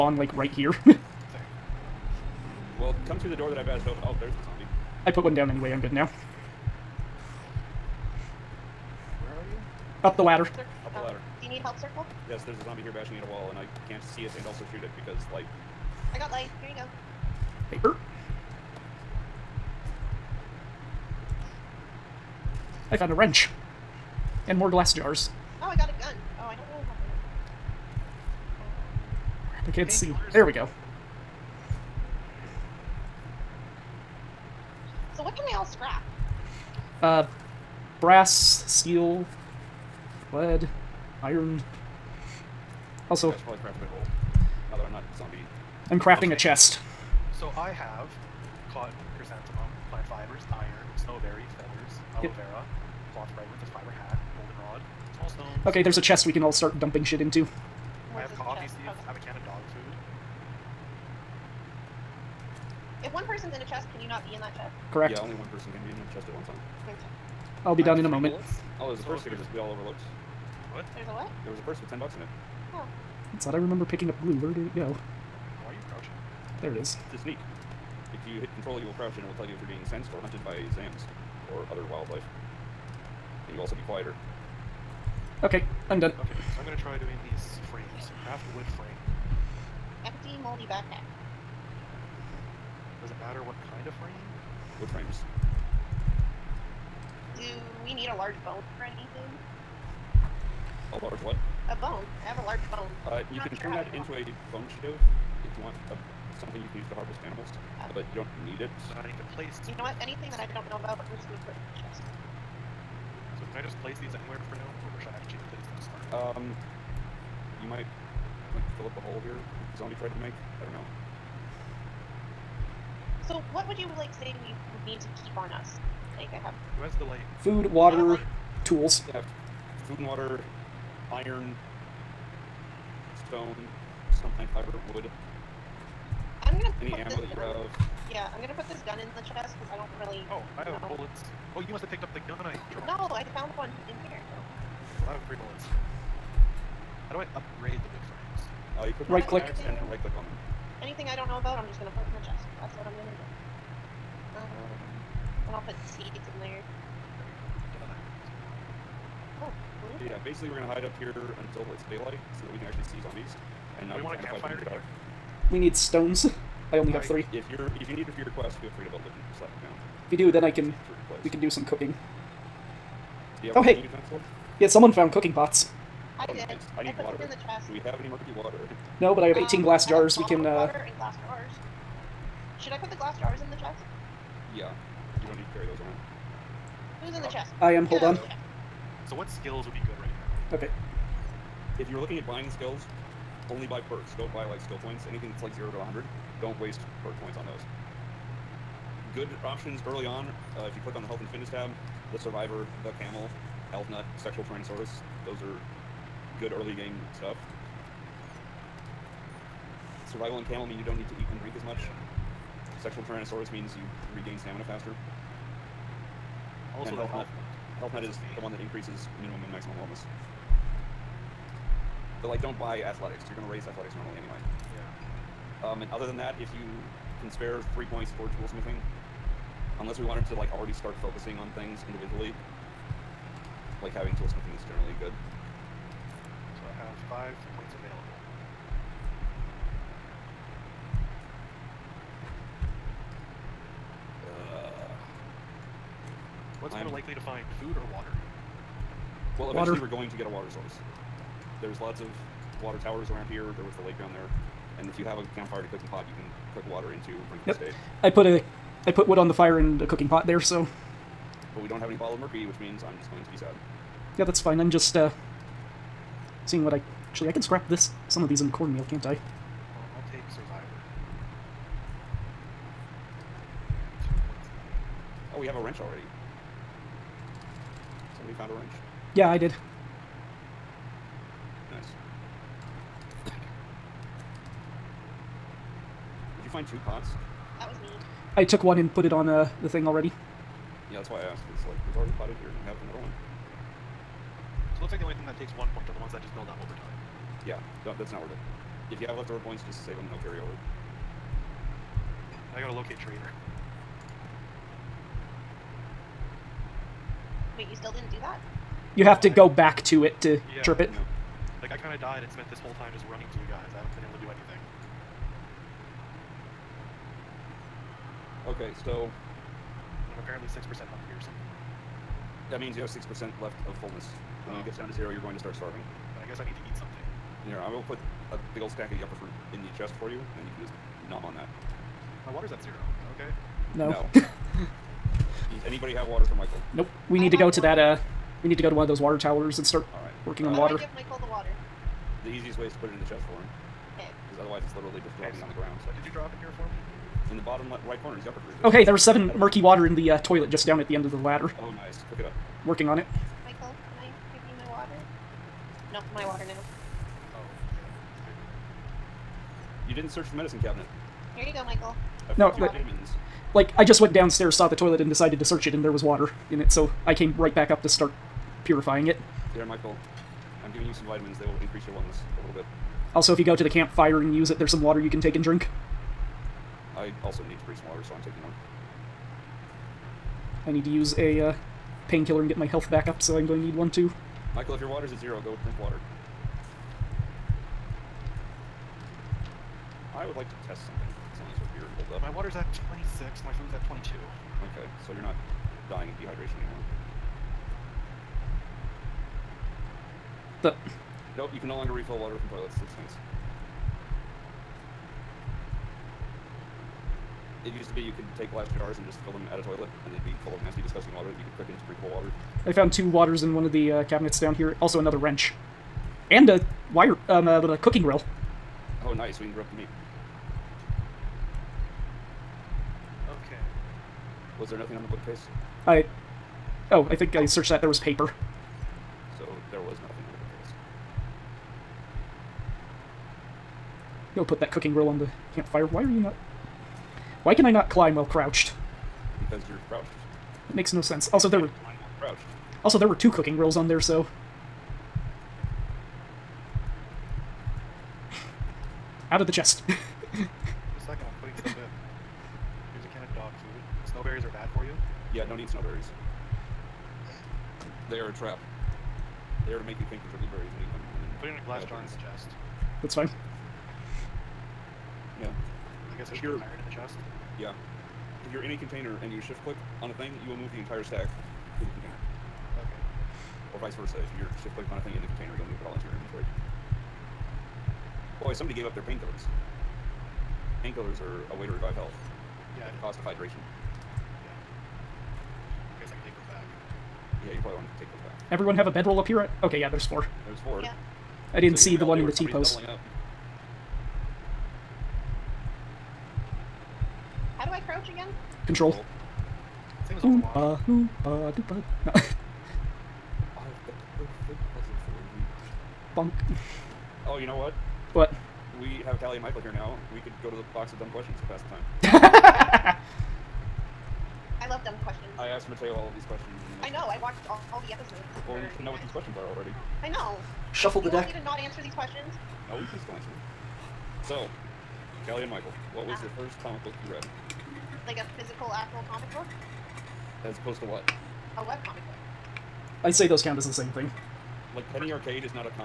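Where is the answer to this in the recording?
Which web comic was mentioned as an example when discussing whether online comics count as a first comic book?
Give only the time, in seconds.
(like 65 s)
534 s.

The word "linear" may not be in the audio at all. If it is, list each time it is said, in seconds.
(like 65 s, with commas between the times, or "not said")
not said.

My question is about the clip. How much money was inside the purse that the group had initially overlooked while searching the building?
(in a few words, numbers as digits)
10 bucks.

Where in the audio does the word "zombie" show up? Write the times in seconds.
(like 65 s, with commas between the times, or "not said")
4 s, 12 s, 119 s, 163 s.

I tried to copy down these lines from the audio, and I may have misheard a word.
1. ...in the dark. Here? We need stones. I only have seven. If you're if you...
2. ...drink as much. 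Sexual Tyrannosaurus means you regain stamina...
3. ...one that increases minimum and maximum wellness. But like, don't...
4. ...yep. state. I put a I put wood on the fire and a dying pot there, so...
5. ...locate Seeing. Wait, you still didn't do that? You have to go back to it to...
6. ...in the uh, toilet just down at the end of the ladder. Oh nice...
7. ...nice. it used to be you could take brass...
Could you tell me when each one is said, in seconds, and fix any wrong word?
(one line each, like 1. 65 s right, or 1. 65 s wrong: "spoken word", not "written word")
1. 164 s wrong: "three", not "seven"
2. 211 s right
3. 218 s right
4. 257 s wrong: "cooking", not "dying"
5. 302 s wrong: "Trader", not "Seeing"
6. 349 s right
7. 407 s wrong: "glass", not "brass".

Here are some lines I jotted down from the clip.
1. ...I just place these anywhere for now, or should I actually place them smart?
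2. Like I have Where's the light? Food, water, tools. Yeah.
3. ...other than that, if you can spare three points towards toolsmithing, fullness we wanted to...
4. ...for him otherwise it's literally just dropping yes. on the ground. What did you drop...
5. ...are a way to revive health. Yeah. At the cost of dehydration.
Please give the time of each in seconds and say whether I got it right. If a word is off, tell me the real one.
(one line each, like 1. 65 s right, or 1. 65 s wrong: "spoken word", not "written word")
1. 113 s right
2. 126 s right
3. 225 s wrong: "unless", not "fullness"
4. 343 s right
5. 481 s wrong: "hydration", not "dehydration".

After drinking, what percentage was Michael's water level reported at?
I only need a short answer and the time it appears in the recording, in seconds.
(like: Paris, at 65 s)
26, at 393 s.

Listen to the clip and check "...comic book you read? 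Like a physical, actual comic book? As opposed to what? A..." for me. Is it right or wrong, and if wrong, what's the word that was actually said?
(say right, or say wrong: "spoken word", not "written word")
right.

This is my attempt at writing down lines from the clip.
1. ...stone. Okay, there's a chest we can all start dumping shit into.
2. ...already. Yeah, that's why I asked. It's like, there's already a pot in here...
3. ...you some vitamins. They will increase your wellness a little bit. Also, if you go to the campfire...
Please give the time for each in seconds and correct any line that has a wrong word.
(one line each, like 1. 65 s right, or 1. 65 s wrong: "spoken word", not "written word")
1. 55 s right
2. 289 s right
3. 370 s right.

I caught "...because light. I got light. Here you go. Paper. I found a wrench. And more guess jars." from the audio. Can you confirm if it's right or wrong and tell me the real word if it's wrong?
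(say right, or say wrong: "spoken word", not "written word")
wrong: "glass", not "guess".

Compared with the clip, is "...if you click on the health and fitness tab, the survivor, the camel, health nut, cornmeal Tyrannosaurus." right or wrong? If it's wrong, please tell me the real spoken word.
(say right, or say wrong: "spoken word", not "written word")
wrong: "sexual", not "cornmeal".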